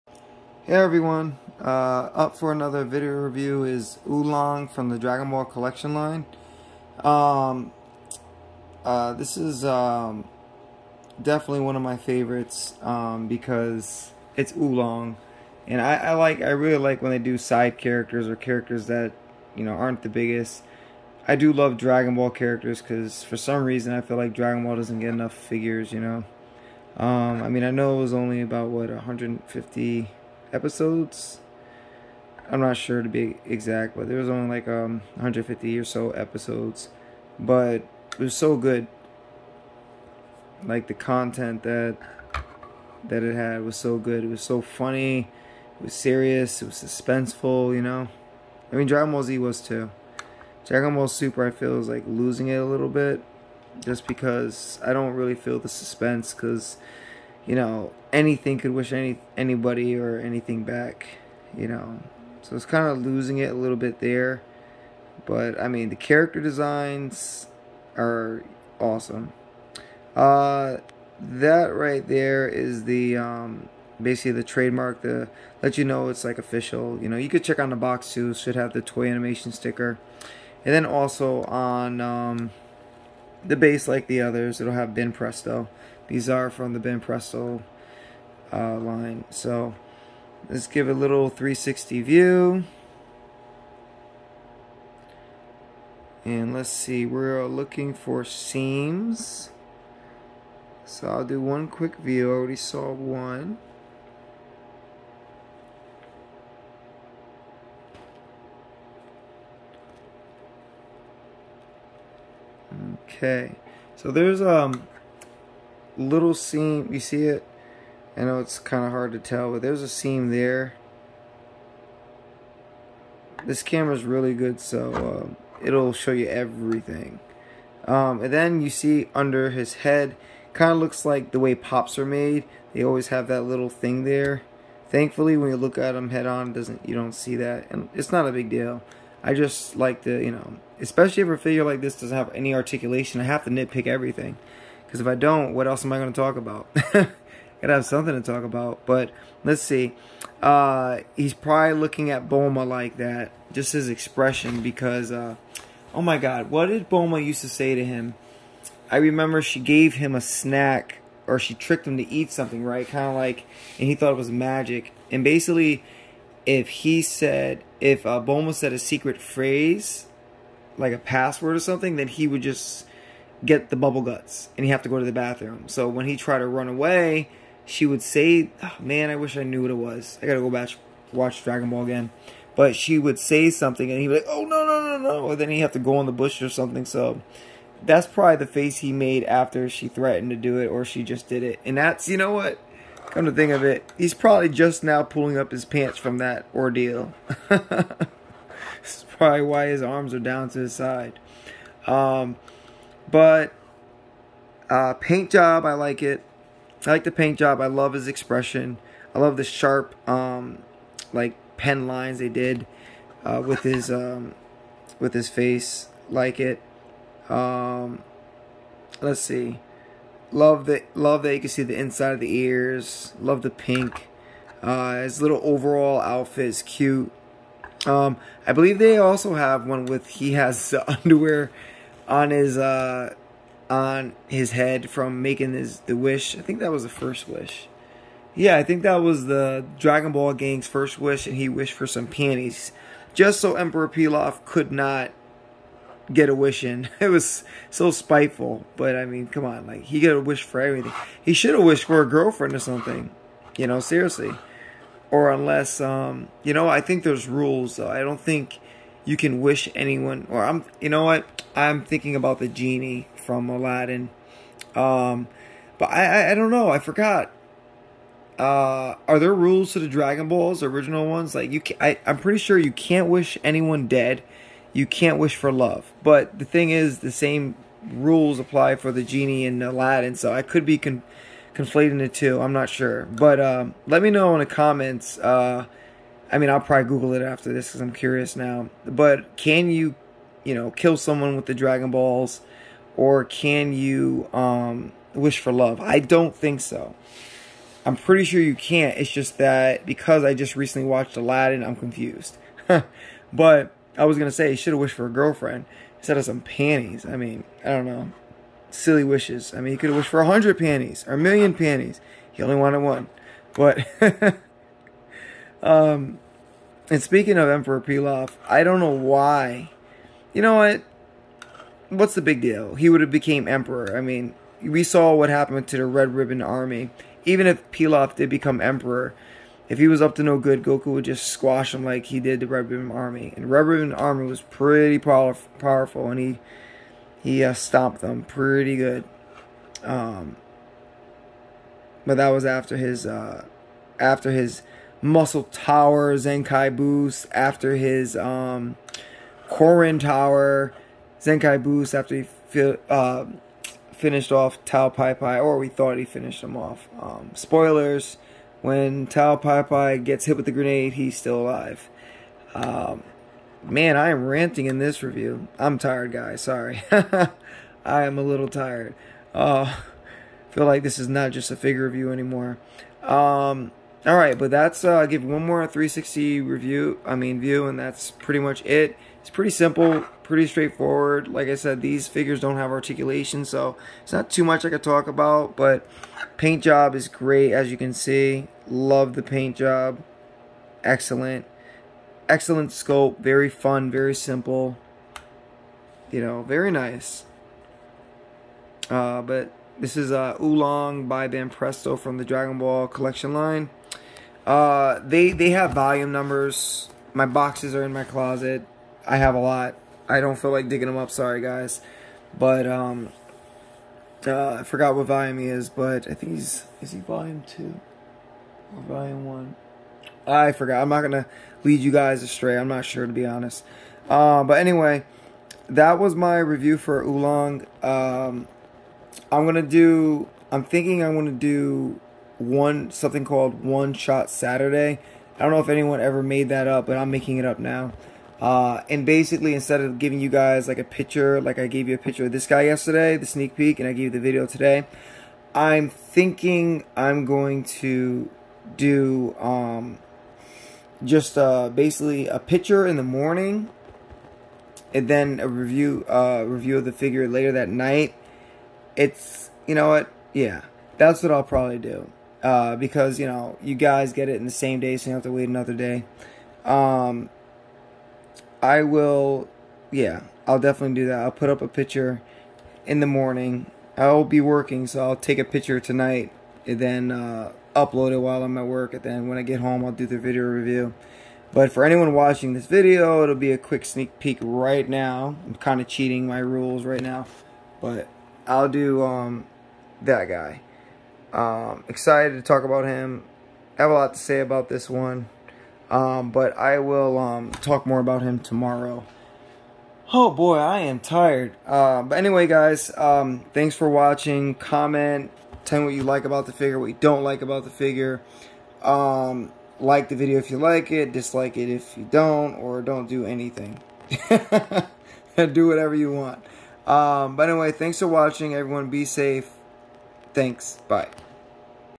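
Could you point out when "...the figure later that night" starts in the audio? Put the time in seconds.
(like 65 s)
456 s.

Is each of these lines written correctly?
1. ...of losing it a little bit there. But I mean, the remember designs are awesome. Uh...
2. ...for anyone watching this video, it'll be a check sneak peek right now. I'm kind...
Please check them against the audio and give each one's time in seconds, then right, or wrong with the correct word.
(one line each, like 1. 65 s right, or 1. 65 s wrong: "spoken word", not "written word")
1. 62 s wrong: "character", not "remember"
2. 481 s wrong: "quick", not "check".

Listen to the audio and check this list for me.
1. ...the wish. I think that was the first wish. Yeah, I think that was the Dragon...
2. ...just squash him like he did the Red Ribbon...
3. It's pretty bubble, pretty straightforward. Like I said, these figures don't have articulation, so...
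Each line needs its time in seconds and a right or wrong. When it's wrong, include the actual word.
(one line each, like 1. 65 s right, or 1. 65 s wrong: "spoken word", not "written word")
1. 235 s right
2. 331 s right
3. 379 s wrong: "simple", not "bubble".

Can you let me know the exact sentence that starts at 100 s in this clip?
So I'll do one quick view.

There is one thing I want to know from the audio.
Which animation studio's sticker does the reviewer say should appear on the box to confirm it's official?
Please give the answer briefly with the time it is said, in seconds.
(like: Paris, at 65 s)
Toei Animation, at 78 s.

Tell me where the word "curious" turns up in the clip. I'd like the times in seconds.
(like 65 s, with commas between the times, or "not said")
287 s.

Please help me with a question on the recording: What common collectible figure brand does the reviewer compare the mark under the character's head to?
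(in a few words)
Pops.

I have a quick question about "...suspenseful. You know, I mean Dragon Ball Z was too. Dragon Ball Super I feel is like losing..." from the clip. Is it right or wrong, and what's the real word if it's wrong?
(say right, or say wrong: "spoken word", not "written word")
right.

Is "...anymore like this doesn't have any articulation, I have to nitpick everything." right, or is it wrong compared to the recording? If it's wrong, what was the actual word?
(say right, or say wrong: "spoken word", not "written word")
wrong: "figure", not "anymore".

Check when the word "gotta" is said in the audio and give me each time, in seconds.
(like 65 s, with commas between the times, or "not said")
146 s, 180 s.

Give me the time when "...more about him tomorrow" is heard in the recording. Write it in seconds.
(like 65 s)
497 s.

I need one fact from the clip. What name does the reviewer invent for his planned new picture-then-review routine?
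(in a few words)
One Shot Saturday.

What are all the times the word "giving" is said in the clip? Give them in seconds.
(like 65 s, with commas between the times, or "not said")
439 s.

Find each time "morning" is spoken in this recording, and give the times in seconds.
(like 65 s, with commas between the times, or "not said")
453 s, 473 s.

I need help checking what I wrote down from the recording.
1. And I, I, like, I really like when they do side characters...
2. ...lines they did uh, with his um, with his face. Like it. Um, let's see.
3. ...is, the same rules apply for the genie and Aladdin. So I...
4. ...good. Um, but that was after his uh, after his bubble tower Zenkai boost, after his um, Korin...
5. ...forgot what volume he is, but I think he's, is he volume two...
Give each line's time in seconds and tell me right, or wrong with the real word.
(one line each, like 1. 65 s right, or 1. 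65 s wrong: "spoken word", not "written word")
1. 15 s right
2. 211 s right
3. 276 s right
4. 338 s wrong: "muscle", not "bubble"
5. 414 s right.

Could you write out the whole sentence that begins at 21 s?
I do love Dragon Ball characters because for some reason I feel like Dragon Ball doesn't get enough figures, you know.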